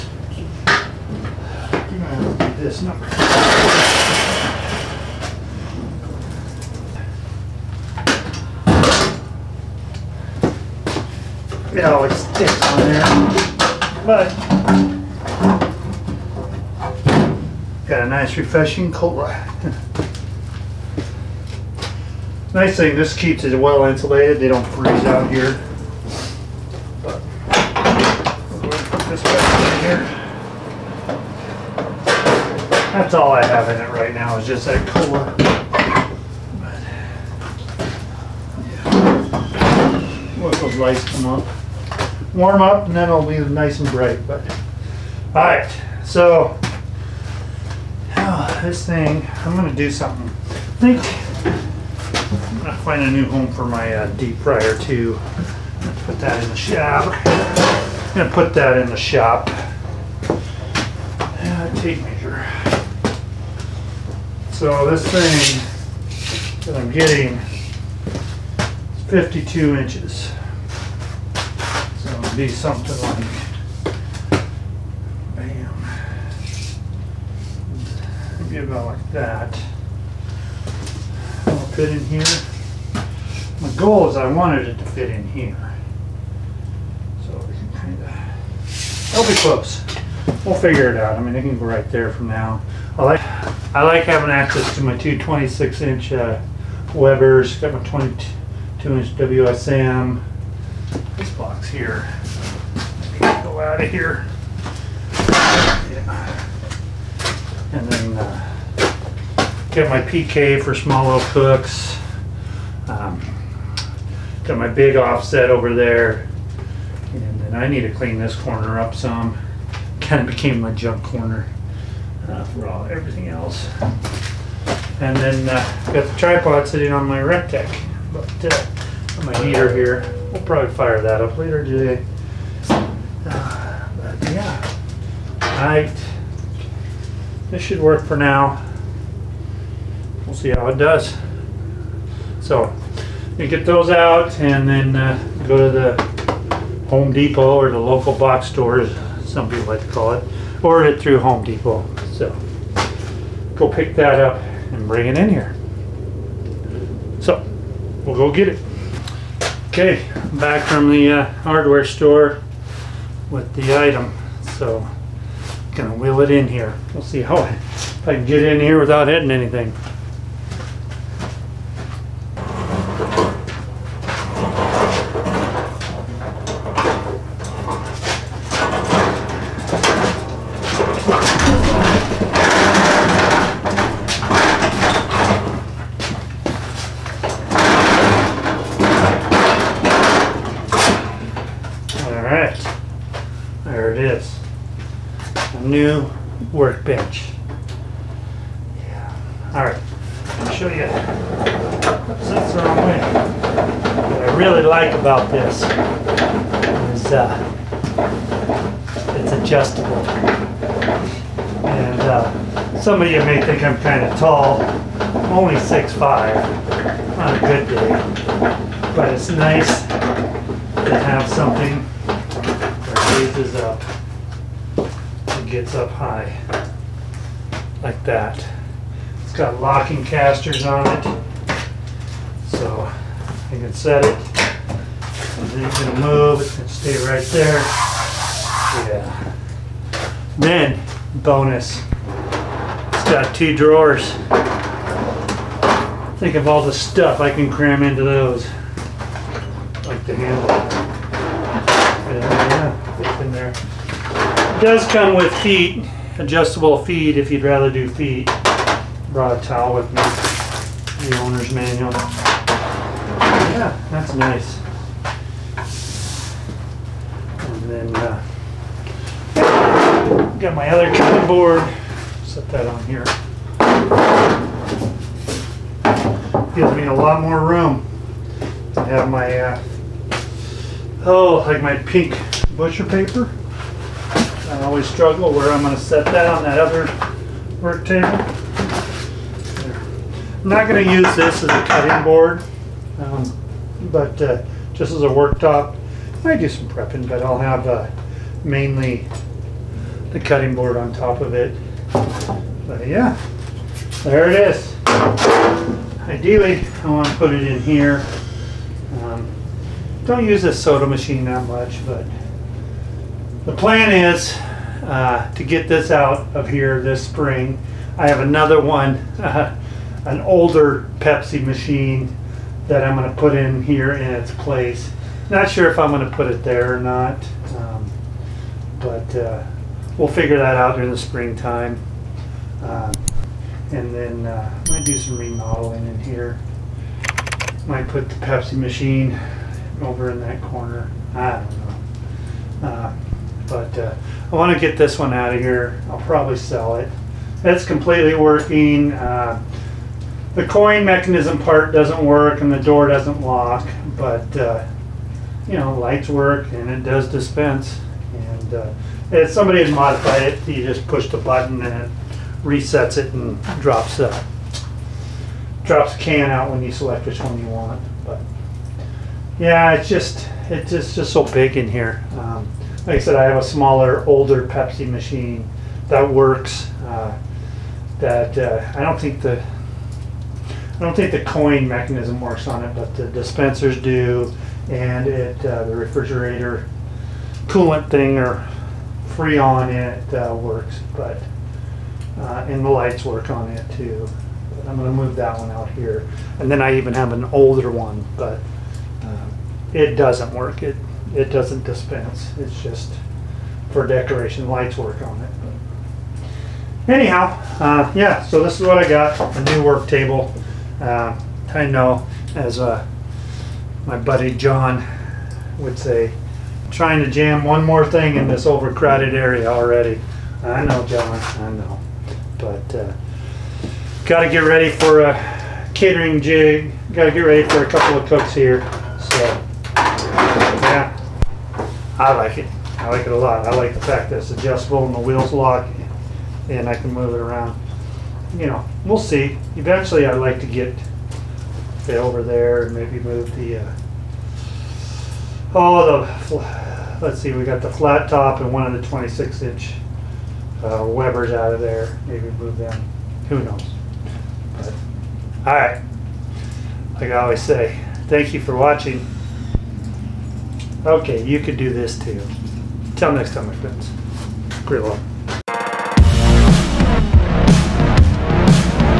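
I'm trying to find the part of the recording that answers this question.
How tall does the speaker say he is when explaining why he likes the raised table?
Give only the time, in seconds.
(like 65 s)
215 s.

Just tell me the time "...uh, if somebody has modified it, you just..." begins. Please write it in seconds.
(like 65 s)
358 s.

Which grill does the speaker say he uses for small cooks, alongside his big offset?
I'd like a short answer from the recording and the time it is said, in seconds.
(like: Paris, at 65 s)
PK, at 110 s.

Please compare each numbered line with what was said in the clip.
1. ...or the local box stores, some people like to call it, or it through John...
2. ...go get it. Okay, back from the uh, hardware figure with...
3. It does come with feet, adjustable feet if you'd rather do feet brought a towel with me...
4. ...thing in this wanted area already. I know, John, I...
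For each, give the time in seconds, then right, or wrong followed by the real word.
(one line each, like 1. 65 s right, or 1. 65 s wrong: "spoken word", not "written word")
1. 147 s wrong: "Home", not "John"
2. 158 s wrong: "store", not "figure"
3. 253 s right
4. 417 s wrong: "overcrowded", not "wanted".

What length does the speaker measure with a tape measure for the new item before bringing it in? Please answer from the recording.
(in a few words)
52 inches.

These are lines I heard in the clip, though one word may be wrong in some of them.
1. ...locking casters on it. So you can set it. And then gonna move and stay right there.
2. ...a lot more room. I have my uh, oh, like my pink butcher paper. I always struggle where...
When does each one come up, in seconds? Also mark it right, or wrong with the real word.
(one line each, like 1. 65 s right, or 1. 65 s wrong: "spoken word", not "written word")
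1. 229 s right
2. 276 s right.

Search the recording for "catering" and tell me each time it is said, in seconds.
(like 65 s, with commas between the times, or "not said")
425 s.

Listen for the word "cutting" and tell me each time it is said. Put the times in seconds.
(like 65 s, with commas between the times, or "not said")
270 s, 291 s, 300 s.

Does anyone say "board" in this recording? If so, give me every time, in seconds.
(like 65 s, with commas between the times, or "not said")
271 s, 292 s, 300 s.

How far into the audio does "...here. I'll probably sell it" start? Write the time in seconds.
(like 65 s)
345 s.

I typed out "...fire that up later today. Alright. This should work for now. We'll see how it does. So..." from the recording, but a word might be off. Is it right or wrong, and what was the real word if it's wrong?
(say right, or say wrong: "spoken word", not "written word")
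right.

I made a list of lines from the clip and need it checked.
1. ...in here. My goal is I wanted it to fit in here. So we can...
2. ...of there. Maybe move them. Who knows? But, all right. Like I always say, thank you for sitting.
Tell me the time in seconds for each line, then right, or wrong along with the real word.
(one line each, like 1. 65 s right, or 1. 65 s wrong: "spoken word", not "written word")
1. 81 s right
2. 451 s wrong: "watching", not "sitting".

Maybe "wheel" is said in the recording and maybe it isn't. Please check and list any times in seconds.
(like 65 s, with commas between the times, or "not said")
165 s, 434 s.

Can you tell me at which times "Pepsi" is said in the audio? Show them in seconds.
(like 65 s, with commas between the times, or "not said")
320 s, 338 s, 374 s.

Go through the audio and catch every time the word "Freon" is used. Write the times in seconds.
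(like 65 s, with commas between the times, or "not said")
389 s.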